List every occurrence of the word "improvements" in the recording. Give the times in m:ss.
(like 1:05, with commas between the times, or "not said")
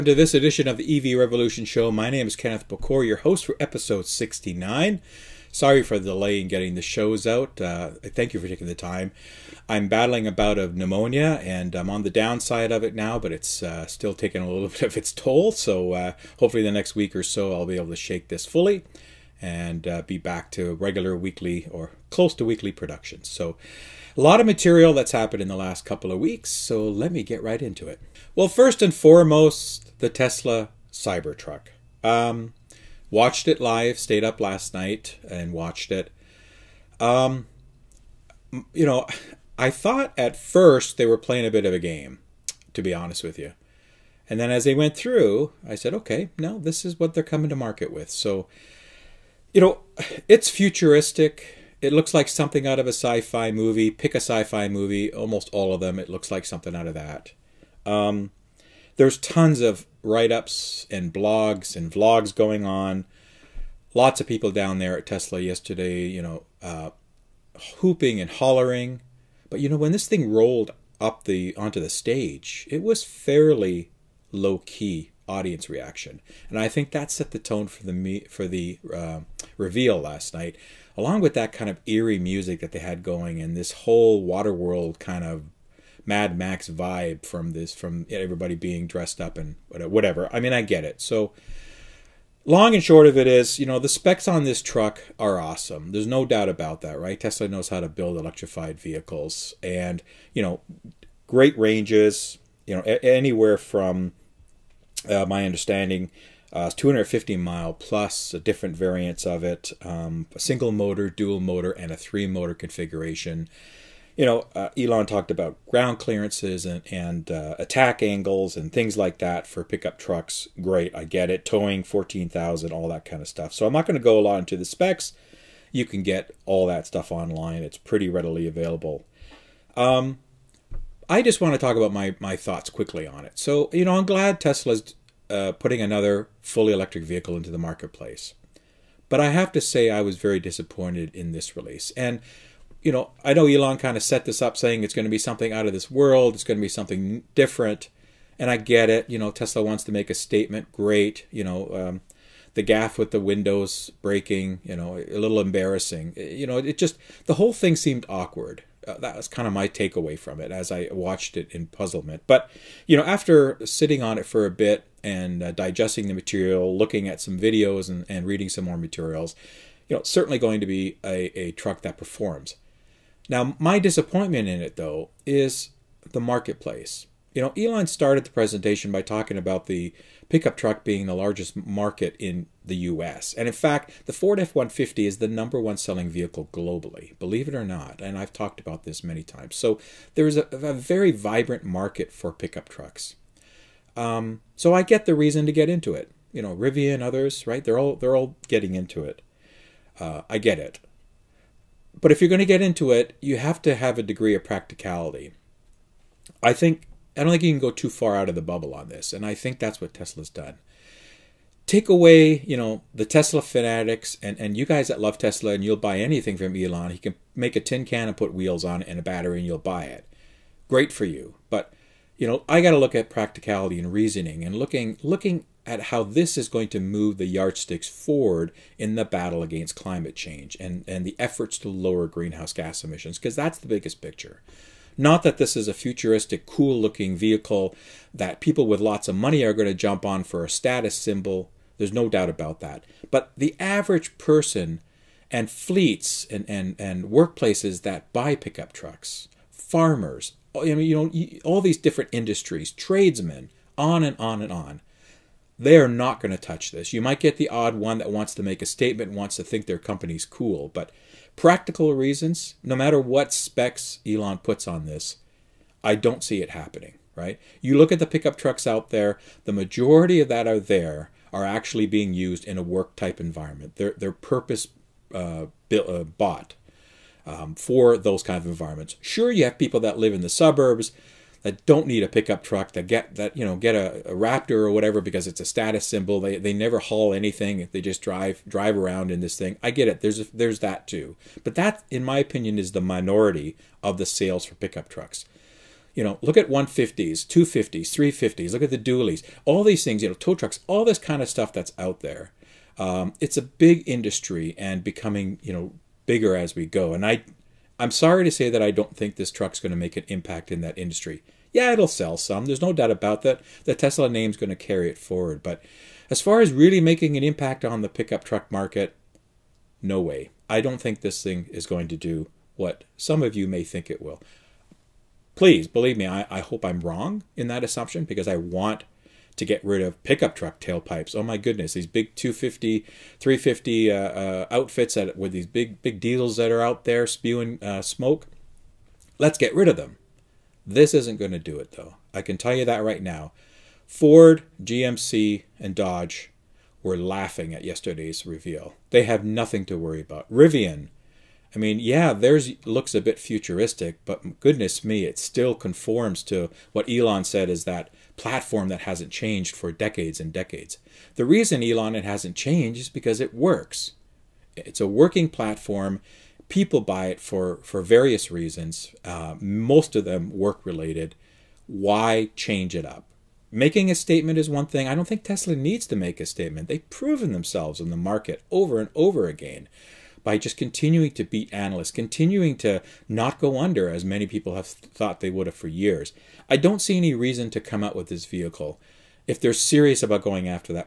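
not said.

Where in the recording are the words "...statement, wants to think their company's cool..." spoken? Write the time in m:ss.
4:18.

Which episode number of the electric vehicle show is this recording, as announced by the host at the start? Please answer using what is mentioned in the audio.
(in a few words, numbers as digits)
69.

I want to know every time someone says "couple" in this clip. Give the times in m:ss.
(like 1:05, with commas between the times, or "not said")
0:25.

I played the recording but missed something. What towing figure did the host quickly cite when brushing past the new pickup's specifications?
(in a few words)
14,000.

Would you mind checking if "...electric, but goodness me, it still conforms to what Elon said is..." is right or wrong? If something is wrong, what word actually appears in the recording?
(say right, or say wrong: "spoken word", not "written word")
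wrong: "futuristic", not "electric".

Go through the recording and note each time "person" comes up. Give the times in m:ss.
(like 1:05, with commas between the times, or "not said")
4:04.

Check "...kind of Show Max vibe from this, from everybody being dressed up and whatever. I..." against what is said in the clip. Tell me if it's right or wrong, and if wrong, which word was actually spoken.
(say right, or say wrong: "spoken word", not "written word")
wrong: "Mad", not "Show".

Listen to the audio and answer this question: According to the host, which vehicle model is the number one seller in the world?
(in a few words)
Ford F-150.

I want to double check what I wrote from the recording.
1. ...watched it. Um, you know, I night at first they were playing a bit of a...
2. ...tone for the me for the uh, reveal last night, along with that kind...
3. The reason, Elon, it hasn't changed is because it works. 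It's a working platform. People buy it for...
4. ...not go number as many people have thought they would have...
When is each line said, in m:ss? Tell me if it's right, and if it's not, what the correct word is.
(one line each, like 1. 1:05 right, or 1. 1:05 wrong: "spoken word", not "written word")
1. 0:35 wrong: "thought", not "night"
2. 1:17 right
3. 6:01 right
4. 6:23 wrong: "under", not "number".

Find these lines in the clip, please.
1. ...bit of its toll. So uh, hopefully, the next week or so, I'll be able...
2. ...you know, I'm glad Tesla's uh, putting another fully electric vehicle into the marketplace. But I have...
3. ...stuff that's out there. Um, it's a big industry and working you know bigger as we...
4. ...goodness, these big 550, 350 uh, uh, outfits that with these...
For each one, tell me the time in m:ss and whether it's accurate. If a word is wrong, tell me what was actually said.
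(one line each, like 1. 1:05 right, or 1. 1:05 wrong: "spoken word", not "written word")
1. 0:14 right
2. 2:13 right
3. 5:01 wrong: "becoming", not "working"
4. 5:31 wrong: "250", not "550".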